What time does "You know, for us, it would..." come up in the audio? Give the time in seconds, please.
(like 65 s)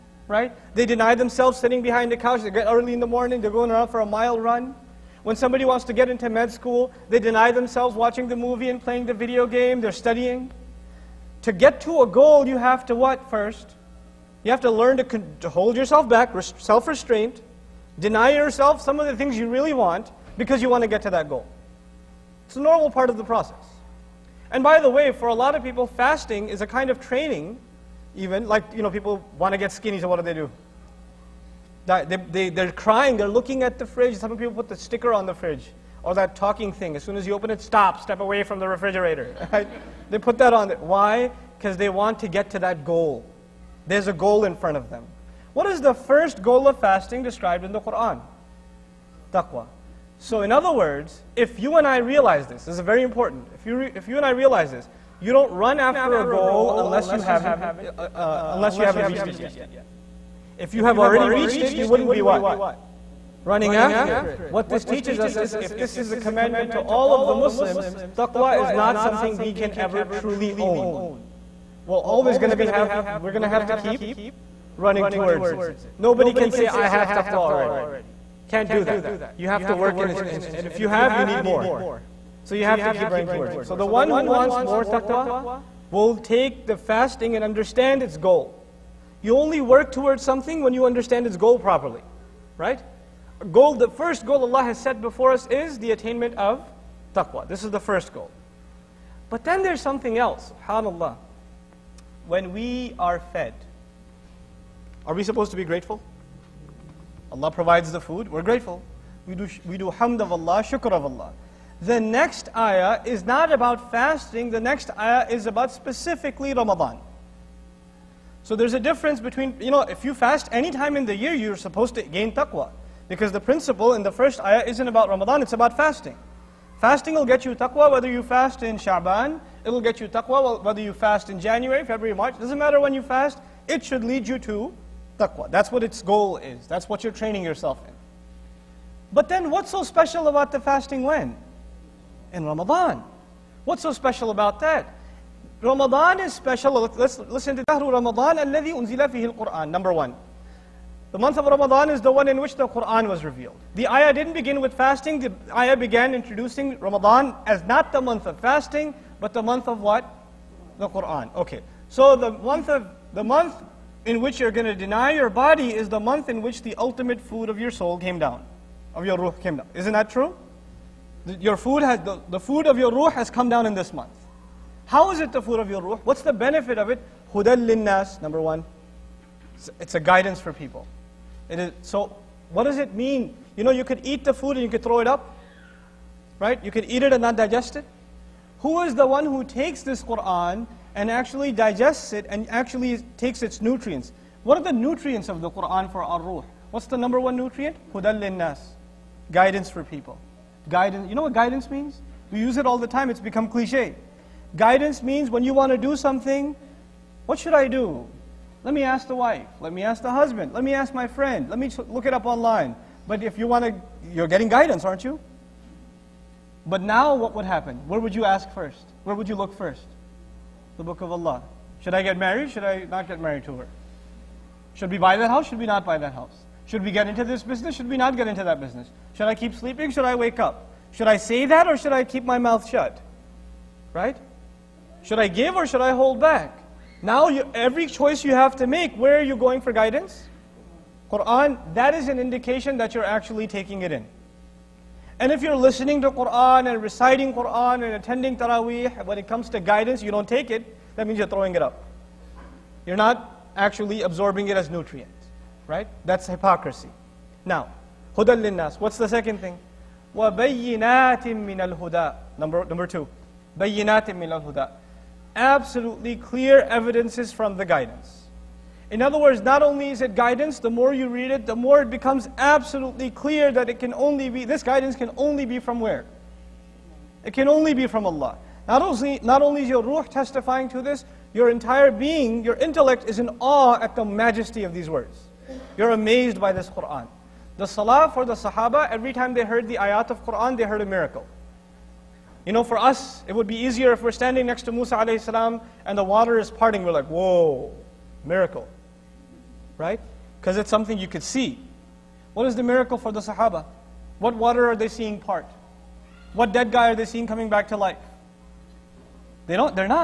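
292 s.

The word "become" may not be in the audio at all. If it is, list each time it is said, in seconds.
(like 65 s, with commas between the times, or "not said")
203 s, 271 s.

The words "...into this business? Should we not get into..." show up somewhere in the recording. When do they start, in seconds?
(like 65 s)
227 s.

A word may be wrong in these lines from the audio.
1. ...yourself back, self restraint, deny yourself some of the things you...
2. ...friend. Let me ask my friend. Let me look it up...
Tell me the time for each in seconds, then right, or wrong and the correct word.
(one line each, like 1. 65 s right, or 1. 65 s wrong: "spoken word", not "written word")
1. 15 s right
2. 210 s wrong: "husband", not "friend".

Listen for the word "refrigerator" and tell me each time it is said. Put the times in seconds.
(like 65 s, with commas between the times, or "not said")
38 s.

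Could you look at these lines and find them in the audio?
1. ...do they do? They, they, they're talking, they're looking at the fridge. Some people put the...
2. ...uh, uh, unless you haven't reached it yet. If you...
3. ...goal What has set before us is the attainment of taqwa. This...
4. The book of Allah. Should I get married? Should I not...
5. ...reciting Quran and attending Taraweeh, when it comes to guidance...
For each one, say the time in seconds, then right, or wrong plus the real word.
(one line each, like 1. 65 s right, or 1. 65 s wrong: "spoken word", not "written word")
1. 30 s wrong: "crying", not "talking"
2. 57 s right
3. 94 s wrong: "Allah", not "What"
4. 220 s right
5. 246 s right.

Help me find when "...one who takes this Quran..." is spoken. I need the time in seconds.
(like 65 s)
189 s.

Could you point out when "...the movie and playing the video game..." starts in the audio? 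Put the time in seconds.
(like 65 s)
8 s.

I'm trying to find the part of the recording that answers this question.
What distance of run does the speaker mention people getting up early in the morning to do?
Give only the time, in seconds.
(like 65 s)
3 s.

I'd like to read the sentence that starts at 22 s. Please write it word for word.
It's a normal part of the process.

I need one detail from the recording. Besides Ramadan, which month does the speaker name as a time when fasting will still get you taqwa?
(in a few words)
Shaban.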